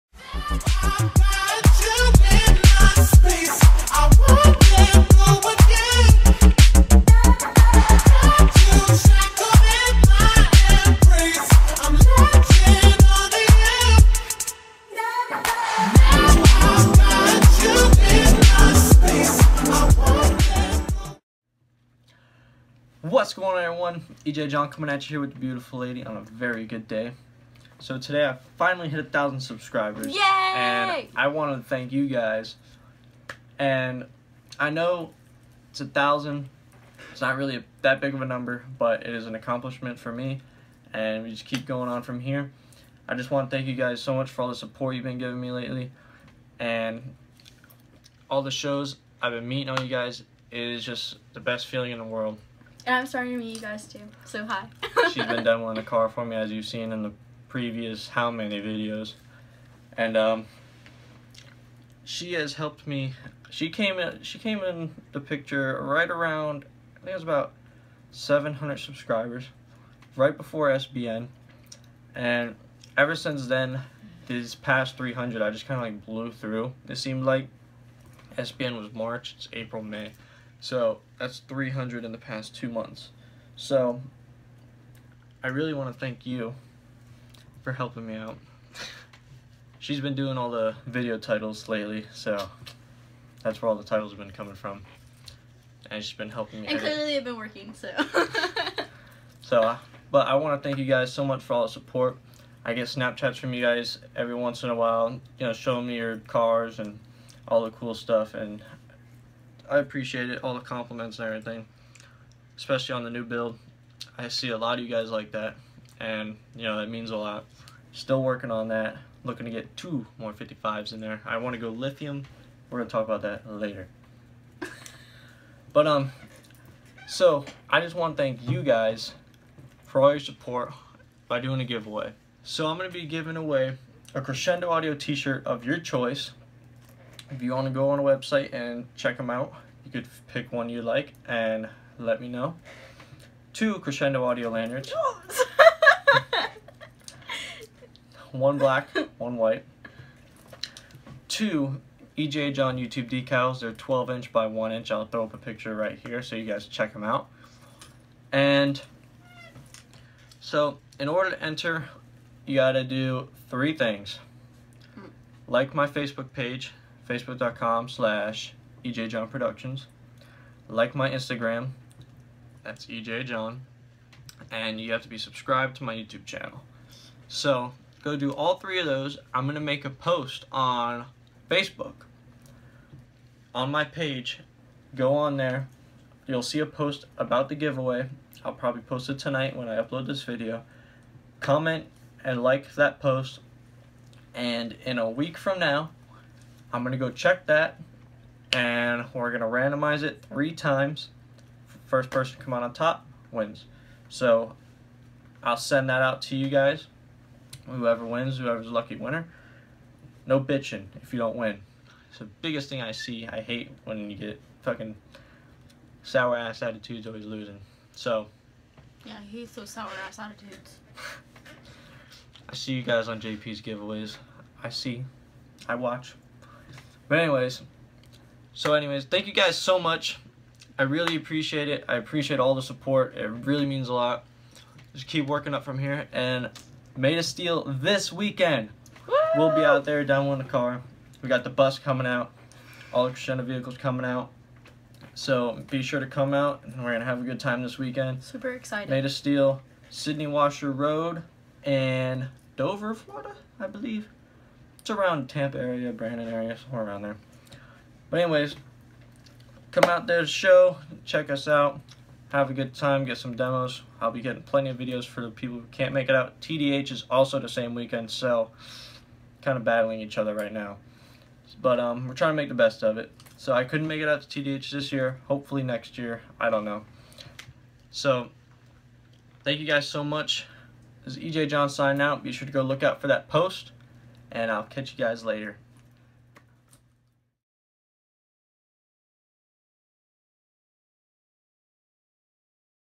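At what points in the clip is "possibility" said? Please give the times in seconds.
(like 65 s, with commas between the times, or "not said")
not said.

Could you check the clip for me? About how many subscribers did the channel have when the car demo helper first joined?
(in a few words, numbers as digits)
700.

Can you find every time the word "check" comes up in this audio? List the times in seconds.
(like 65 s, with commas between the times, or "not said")
138 s, 156 s, 197 s, 261 s.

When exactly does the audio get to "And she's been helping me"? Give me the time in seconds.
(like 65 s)
95 s.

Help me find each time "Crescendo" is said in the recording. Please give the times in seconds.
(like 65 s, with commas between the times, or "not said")
134 s, 143 s, 243 s.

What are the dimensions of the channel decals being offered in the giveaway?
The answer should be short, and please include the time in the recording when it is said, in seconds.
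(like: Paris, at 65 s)
12 inch by 1 inch, at 153 s.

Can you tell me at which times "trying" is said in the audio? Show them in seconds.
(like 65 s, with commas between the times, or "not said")
272 s.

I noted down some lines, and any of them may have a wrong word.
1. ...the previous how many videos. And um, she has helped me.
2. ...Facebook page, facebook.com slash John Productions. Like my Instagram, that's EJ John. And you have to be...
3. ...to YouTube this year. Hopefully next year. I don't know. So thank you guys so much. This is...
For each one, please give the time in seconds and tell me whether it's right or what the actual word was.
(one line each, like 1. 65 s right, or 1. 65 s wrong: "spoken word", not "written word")
1. 57 s right
2. 165 s right
3. 274 s wrong: "TDH", not "YouTube".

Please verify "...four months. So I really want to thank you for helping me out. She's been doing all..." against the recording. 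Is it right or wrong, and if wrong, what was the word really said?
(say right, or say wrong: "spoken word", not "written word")
wrong: "two", not "four".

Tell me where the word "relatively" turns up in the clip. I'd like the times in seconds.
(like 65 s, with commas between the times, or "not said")
not said.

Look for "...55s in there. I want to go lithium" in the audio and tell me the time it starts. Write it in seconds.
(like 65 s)
120 s.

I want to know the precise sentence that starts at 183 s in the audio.
On my page, go on there.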